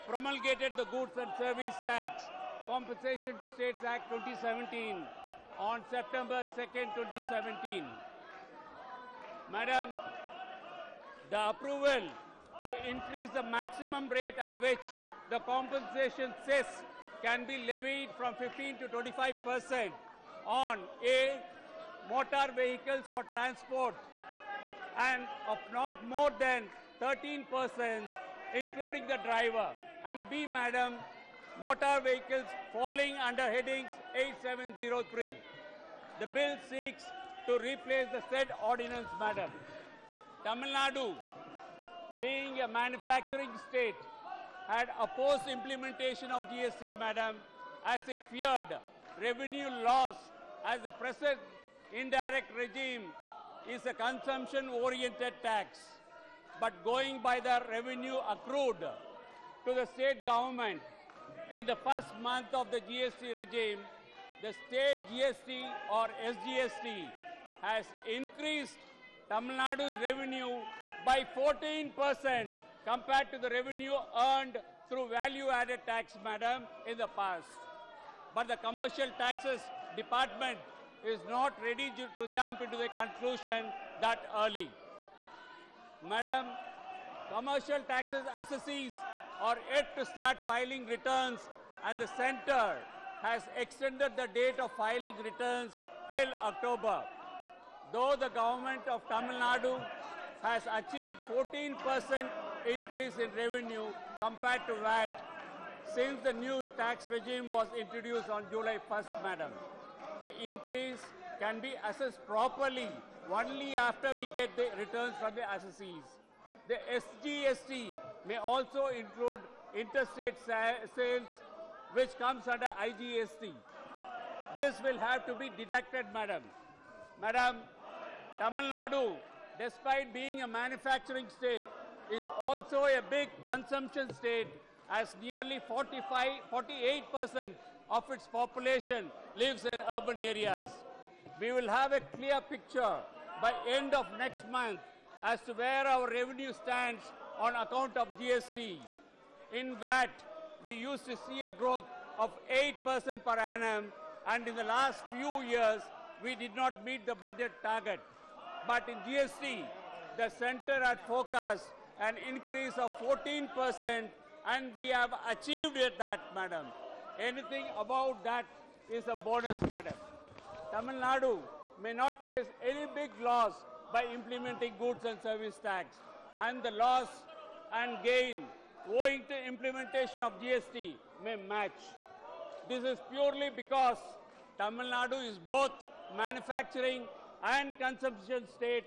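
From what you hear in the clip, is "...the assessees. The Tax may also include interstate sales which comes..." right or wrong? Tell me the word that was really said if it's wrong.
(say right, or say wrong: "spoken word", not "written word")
wrong: "SGST", not "Tax".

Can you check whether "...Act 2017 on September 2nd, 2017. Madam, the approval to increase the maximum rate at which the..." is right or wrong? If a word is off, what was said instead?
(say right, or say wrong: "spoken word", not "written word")
right.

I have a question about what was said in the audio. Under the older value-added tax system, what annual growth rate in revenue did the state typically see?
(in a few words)
8%.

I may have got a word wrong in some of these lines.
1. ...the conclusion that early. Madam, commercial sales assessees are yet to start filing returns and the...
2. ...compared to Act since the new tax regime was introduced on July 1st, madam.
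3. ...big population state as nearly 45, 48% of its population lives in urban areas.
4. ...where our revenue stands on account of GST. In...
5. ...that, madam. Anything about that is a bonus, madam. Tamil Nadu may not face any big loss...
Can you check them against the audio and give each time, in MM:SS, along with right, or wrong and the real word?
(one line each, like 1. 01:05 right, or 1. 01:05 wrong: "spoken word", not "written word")
1. 01:22 wrong: "taxes", not "sales"
2. 01:44 wrong: "VAT", not "Act"
3. 02:13 wrong: "consumption", not "population"
4. 02:25 right
5. 02:45 right.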